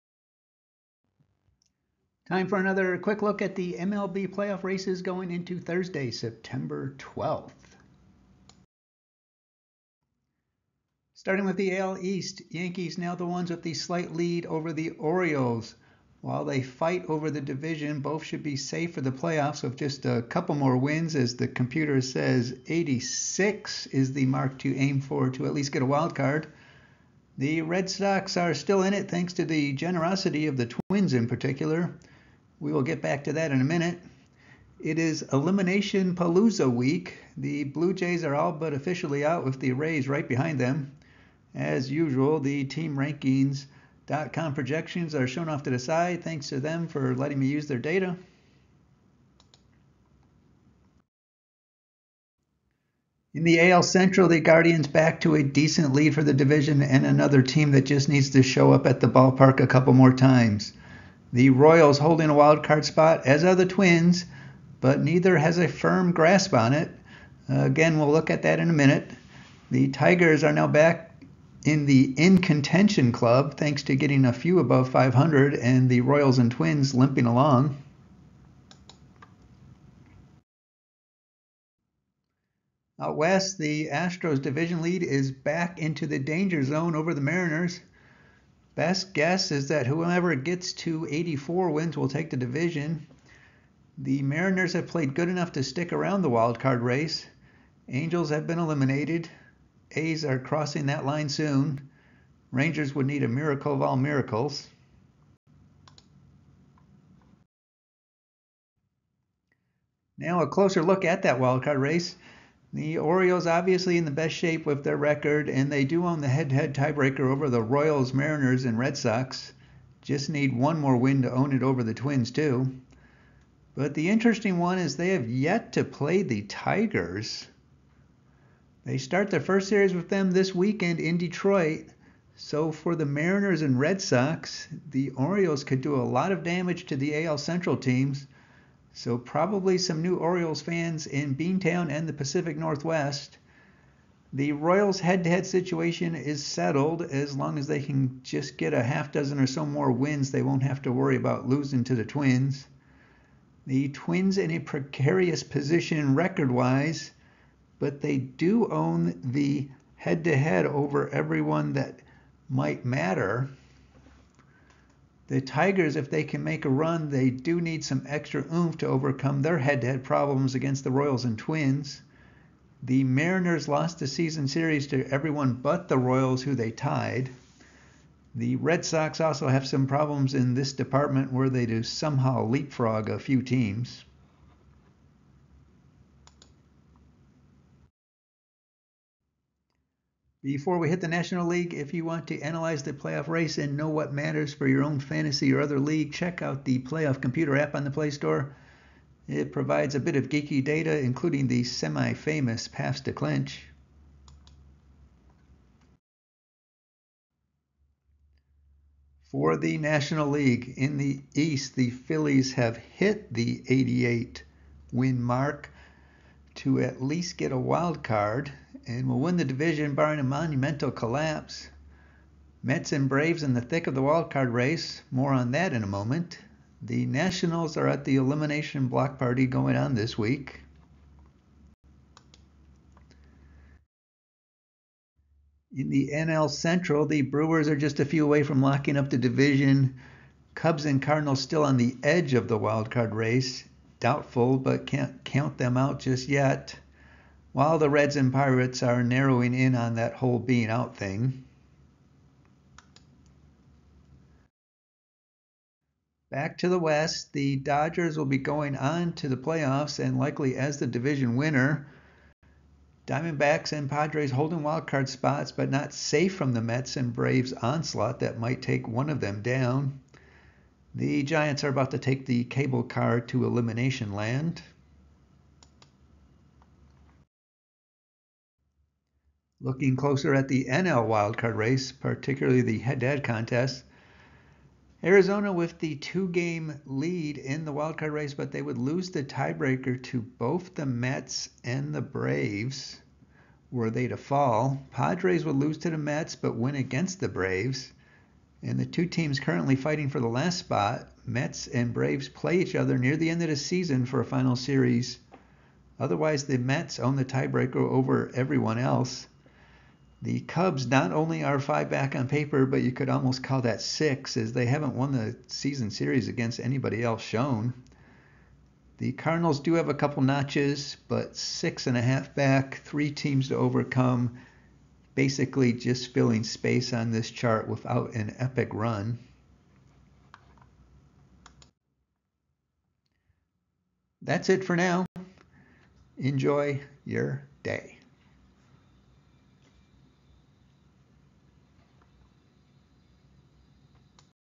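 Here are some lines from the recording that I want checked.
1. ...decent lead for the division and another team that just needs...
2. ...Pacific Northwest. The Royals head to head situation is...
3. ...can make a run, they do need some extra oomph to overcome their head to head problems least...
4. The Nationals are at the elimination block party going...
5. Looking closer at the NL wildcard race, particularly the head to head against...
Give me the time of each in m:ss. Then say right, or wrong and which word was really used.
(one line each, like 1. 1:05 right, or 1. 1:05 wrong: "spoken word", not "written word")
1. 0:55 right
2. 2:22 right
3. 2:46 wrong: "against", not "least"
4. 3:46 right
5. 4:39 wrong: "contest", not "against".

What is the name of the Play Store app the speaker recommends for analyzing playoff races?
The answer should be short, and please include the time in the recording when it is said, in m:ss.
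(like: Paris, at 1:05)
Playoff Computer, at 3:16.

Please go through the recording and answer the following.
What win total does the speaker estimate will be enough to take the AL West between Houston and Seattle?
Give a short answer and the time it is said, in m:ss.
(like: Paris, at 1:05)
84, at 1:31.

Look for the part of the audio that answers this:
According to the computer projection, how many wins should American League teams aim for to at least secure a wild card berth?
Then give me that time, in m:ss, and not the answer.
0:22.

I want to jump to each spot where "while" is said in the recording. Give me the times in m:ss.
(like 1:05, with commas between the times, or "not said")
0:16, 4:07.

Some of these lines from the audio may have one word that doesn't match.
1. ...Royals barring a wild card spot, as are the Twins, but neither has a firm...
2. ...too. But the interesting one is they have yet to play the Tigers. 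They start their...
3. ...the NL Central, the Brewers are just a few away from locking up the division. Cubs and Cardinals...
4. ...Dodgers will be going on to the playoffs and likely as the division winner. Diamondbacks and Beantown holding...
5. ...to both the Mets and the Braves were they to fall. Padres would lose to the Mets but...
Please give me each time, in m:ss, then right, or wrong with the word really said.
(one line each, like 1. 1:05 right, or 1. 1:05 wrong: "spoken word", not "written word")
1. 1:01 wrong: "holding", not "barring"
2. 2:02 right
3. 3:55 right
4. 4:17 wrong: "Padres", not "Beantown"
5. 4:50 right.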